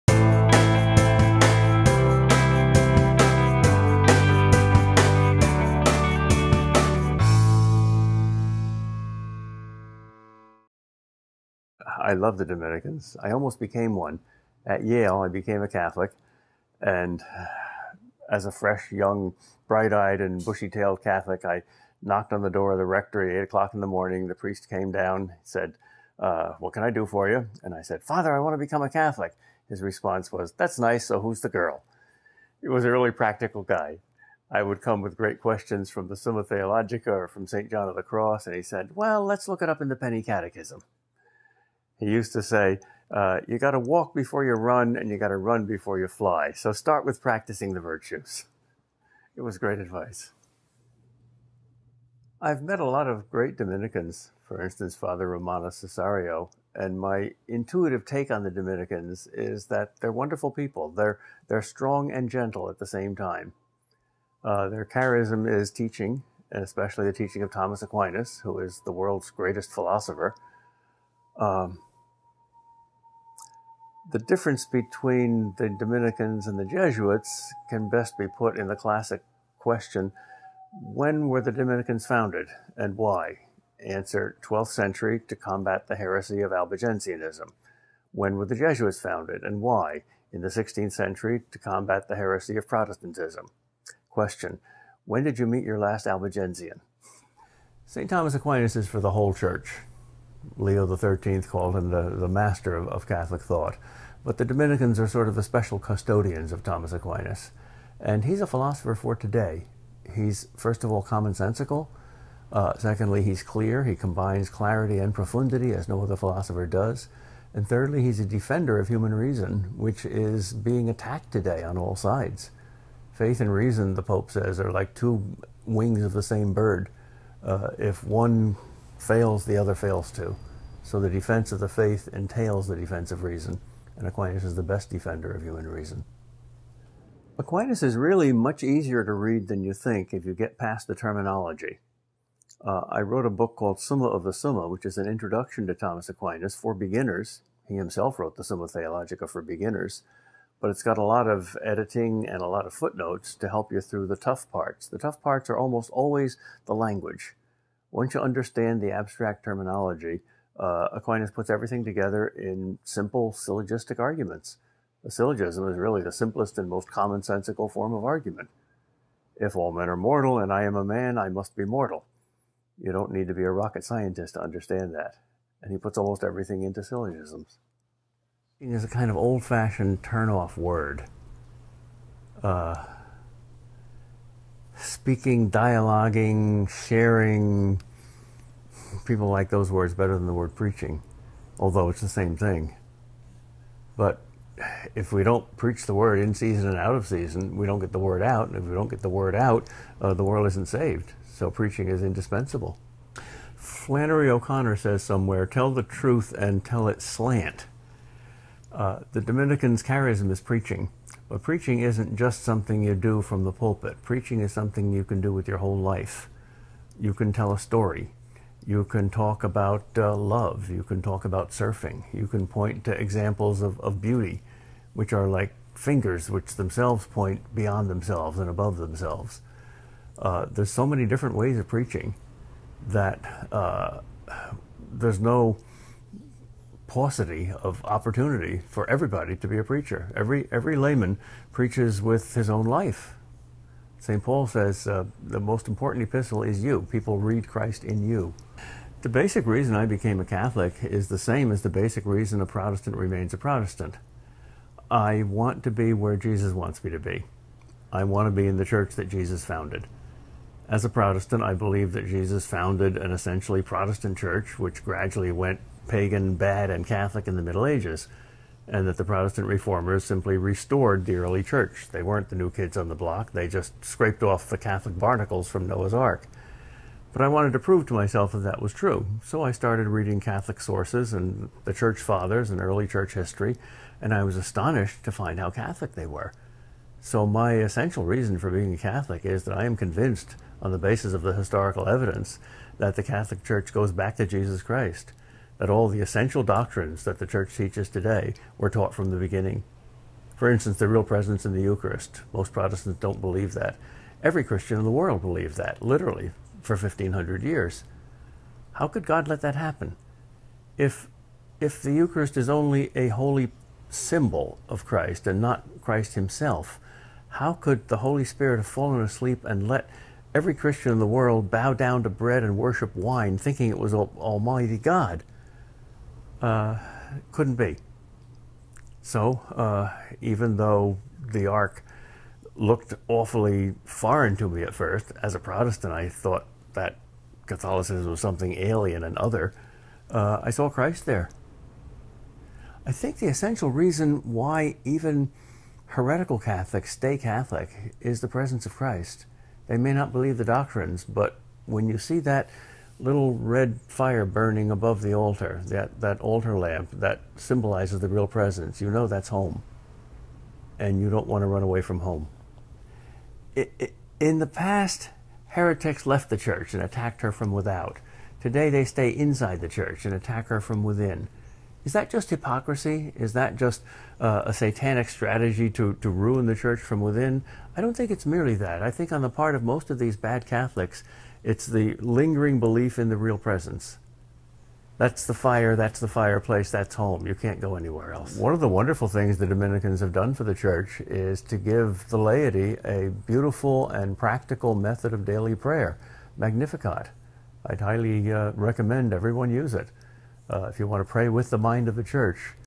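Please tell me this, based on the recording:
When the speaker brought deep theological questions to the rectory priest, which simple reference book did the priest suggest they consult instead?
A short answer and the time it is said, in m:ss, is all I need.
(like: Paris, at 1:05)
Penny Catechism, at 0:39.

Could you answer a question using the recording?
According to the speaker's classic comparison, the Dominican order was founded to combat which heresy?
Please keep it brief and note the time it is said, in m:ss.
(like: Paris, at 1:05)
Albigensianism, at 1:26.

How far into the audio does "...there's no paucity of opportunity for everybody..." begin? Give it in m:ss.
3:54.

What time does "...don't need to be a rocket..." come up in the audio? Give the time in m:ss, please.
2:52.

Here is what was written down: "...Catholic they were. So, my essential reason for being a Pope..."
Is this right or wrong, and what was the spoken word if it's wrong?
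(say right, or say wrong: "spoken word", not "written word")
wrong: "Catholic", not "Pope".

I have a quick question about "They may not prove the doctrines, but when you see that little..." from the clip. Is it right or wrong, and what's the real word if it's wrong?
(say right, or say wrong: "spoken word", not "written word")
wrong: "believe", not "prove".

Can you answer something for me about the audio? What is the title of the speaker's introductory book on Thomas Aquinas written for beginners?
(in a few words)
Summa of the Summa.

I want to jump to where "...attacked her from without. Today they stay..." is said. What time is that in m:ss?
6:06.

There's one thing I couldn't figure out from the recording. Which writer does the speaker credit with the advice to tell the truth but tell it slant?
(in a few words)
Flannery O'Connor.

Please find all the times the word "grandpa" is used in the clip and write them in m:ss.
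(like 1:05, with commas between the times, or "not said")
not said.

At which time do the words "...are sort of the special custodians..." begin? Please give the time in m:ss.
1:44.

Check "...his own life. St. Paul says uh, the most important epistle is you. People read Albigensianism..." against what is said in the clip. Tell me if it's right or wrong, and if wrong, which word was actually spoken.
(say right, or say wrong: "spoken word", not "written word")
wrong: "Christ", not "Albigensianism".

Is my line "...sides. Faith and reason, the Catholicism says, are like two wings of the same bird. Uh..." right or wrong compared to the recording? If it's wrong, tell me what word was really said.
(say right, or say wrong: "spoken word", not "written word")
wrong: "Pope", not "Catholicism".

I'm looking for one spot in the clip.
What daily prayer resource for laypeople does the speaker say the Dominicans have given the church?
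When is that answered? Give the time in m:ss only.
6:36.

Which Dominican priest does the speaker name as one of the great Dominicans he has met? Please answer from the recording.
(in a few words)
Romano Cessario.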